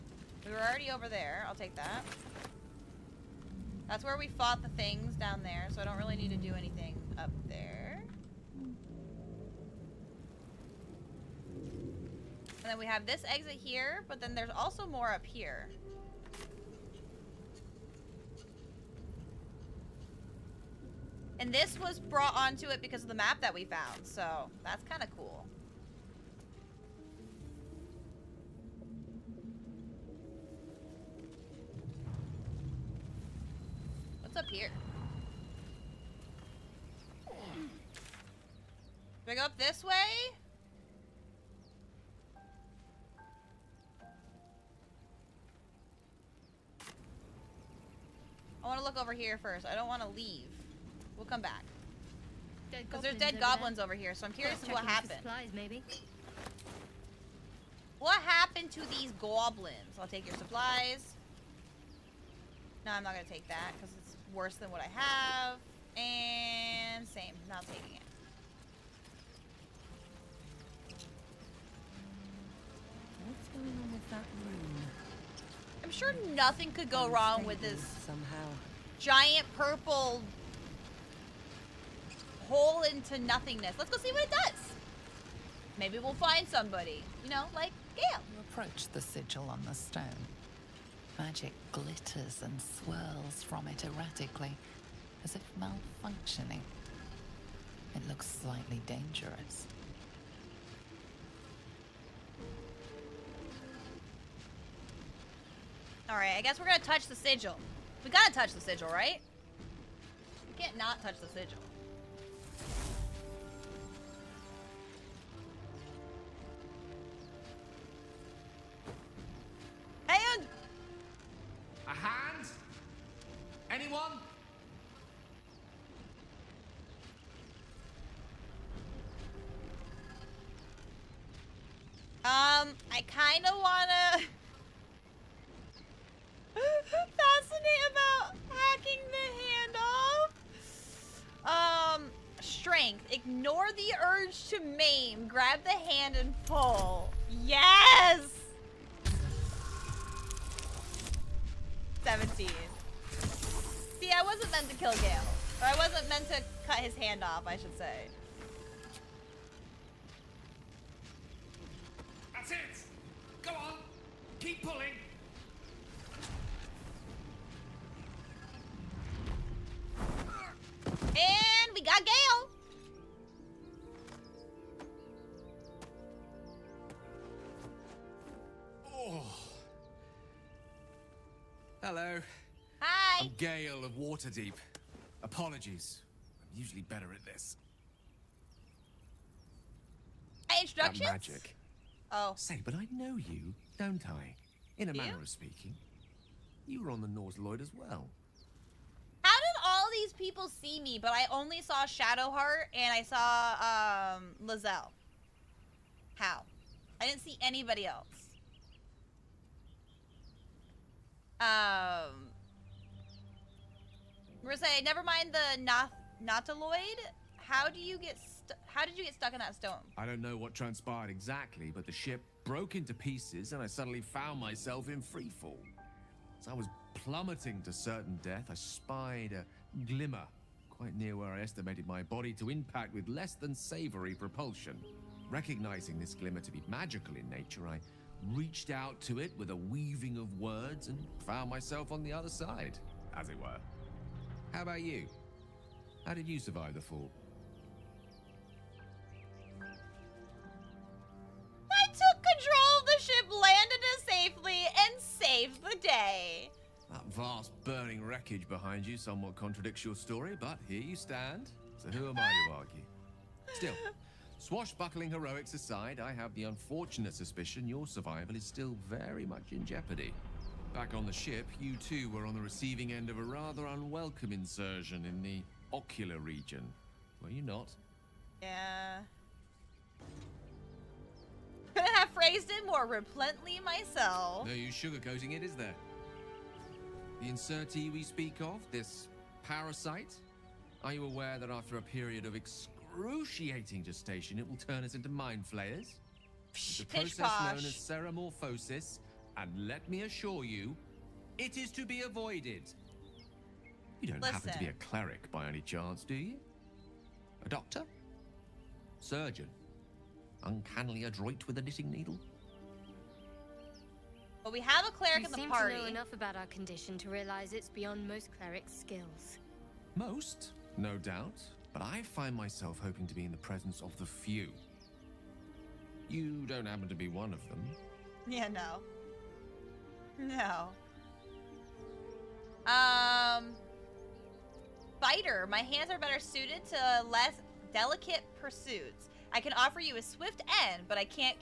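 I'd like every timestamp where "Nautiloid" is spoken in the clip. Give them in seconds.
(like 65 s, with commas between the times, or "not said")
197 s, 216 s.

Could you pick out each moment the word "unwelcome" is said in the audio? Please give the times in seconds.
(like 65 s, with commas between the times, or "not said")
273 s.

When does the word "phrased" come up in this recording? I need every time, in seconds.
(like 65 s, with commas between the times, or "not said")
282 s.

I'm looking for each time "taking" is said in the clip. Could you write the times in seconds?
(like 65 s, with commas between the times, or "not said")
67 s.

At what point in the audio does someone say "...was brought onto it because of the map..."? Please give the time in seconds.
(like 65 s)
21 s.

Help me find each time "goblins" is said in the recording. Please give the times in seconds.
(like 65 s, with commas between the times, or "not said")
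53 s, 59 s.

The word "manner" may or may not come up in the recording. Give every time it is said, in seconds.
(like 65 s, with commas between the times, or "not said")
194 s.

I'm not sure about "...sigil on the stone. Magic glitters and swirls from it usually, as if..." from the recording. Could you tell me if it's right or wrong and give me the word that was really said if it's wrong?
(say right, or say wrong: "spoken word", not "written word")
wrong: "erratically", not "usually".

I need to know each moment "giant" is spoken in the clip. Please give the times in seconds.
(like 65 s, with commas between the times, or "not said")
78 s.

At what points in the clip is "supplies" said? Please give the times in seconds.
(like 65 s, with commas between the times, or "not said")
55 s, 60 s.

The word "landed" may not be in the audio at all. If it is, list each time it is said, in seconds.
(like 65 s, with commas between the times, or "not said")
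253 s.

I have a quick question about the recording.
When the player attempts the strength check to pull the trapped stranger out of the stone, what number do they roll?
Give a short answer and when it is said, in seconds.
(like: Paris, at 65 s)
17, at 152 s.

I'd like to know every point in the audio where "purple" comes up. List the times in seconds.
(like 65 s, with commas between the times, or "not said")
79 s.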